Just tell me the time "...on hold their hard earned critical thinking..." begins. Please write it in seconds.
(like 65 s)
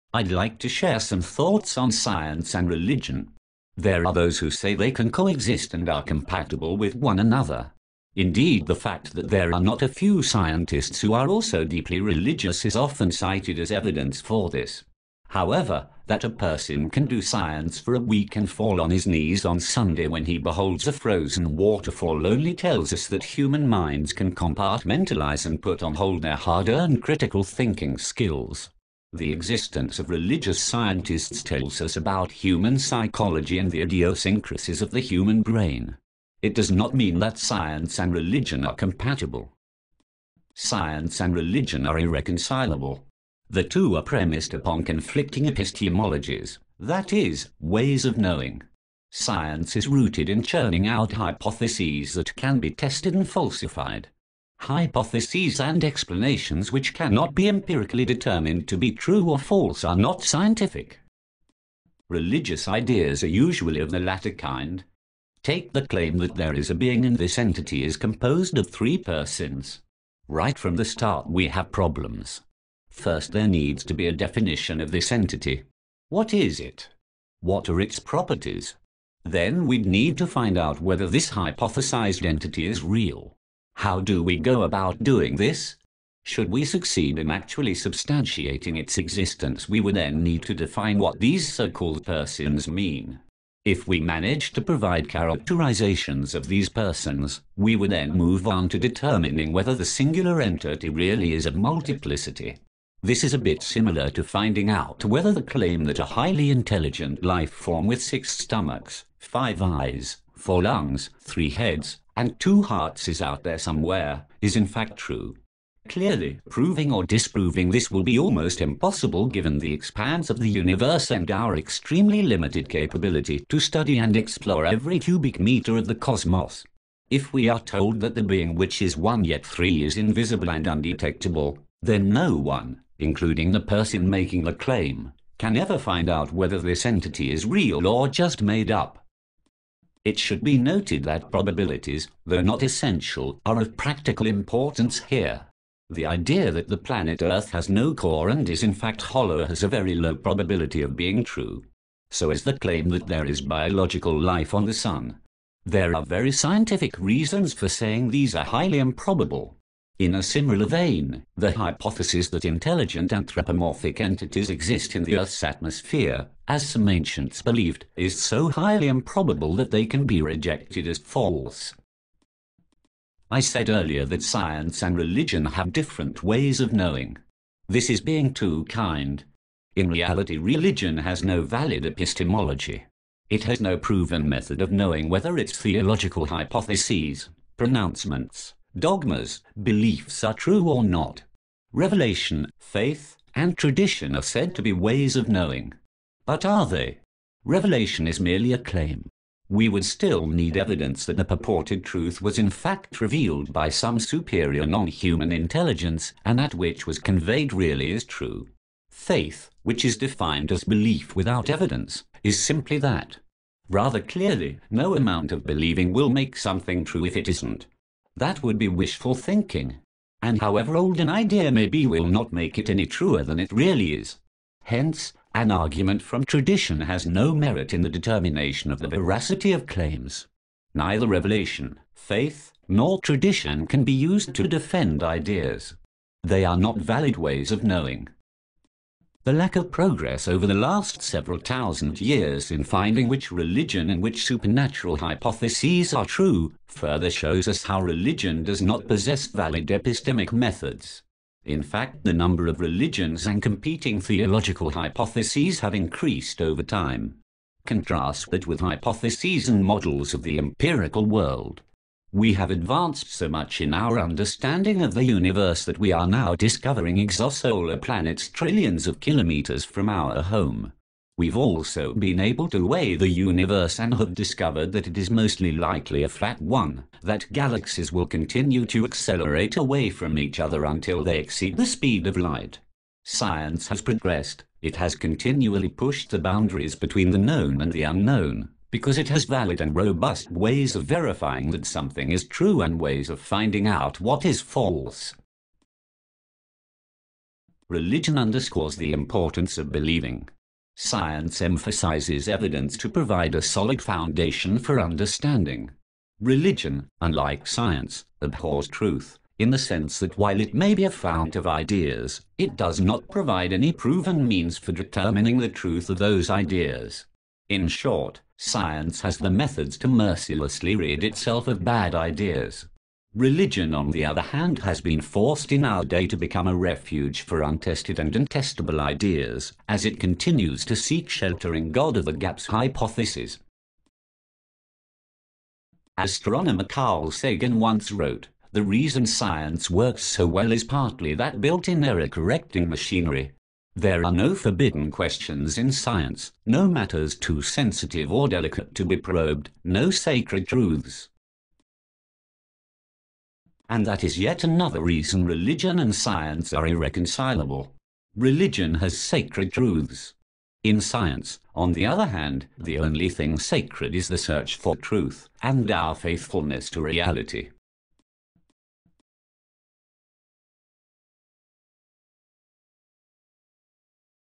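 25 s.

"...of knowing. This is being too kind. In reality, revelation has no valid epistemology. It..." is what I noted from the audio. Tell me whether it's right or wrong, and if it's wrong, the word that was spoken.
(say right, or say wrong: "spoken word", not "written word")
wrong: "religion", not "revelation".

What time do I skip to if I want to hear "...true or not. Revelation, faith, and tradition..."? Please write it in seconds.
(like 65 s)
190 s.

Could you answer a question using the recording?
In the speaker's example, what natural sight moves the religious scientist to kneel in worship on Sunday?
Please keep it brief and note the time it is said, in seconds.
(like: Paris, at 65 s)
a frozen waterfall, at 20 s.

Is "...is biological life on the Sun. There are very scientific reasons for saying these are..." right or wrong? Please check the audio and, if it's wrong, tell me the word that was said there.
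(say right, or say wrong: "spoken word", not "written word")
right.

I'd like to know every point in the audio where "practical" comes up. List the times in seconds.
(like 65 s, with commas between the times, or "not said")
143 s.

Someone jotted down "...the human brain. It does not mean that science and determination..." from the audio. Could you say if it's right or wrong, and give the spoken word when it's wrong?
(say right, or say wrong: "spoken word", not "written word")
wrong: "religion", not "determination".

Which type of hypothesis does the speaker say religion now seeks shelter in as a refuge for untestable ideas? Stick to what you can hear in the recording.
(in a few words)
God of the Gaps.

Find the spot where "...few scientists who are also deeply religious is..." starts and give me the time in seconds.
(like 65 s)
9 s.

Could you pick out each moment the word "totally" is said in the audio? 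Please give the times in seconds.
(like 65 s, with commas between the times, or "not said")
not said.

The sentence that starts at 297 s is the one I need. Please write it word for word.
Religion underscores the importance of believing.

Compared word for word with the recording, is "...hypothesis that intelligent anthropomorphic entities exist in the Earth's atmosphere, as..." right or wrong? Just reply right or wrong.
right.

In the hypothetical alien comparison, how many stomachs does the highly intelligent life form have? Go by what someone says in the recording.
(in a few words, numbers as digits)
6.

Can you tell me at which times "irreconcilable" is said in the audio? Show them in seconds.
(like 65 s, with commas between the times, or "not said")
41 s, 356 s.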